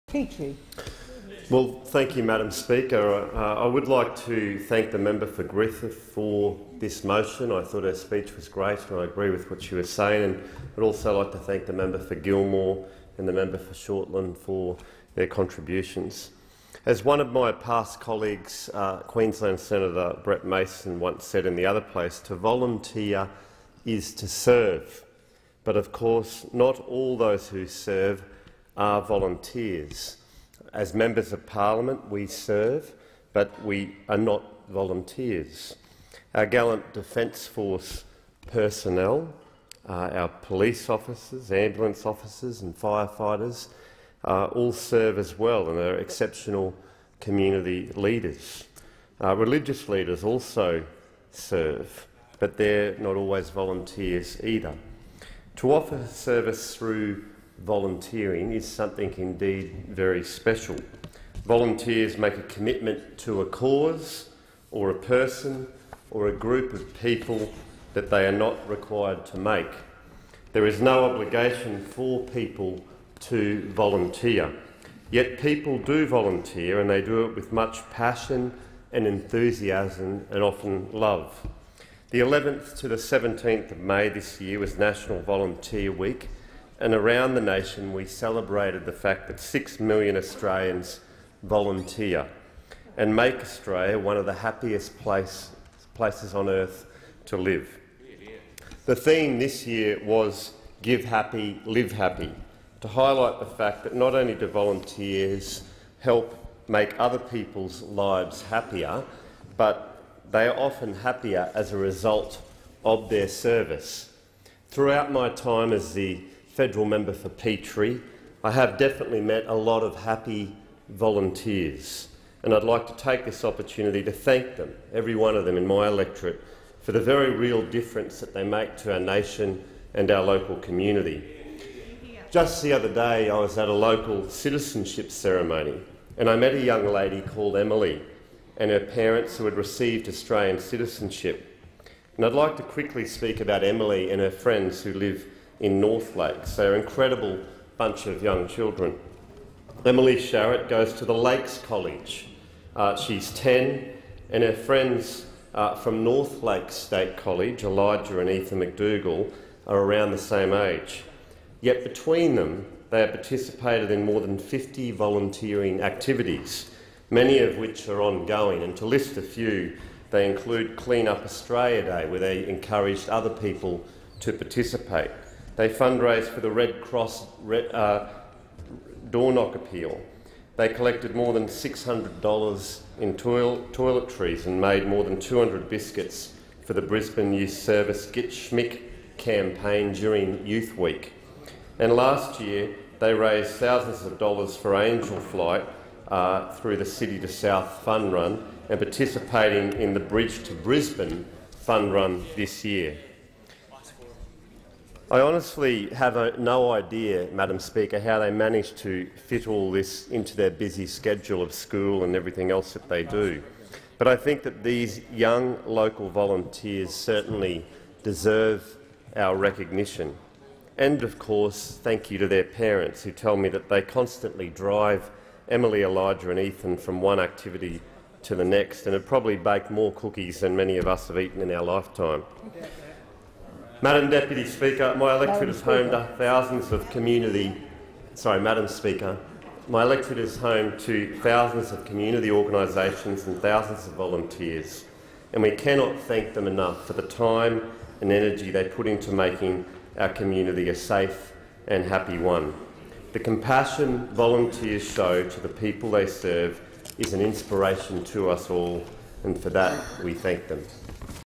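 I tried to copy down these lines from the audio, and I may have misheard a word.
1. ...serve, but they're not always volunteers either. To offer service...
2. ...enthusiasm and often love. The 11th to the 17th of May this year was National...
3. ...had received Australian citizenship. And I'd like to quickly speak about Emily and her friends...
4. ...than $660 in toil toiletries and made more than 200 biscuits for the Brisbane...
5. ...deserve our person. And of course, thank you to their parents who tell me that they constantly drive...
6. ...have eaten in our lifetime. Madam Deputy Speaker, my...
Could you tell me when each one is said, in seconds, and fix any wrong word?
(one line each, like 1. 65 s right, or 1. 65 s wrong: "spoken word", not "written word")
1. 51 s right
2. 79 s right
3. 139 s right
4. 181 s wrong: "600", not "660"
5. 218 s wrong: "recognition", not "person"
6. 231 s right.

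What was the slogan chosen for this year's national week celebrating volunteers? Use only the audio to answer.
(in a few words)
Give Happy, Live Happy.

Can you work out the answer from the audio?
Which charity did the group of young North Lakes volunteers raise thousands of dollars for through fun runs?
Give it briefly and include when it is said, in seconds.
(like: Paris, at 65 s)
Angel Flight, at 194 s.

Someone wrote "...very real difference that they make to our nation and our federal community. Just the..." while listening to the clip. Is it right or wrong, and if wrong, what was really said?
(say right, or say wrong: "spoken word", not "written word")
wrong: "local", not "federal".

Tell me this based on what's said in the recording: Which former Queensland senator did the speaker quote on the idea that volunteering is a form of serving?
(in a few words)
Brett Mason.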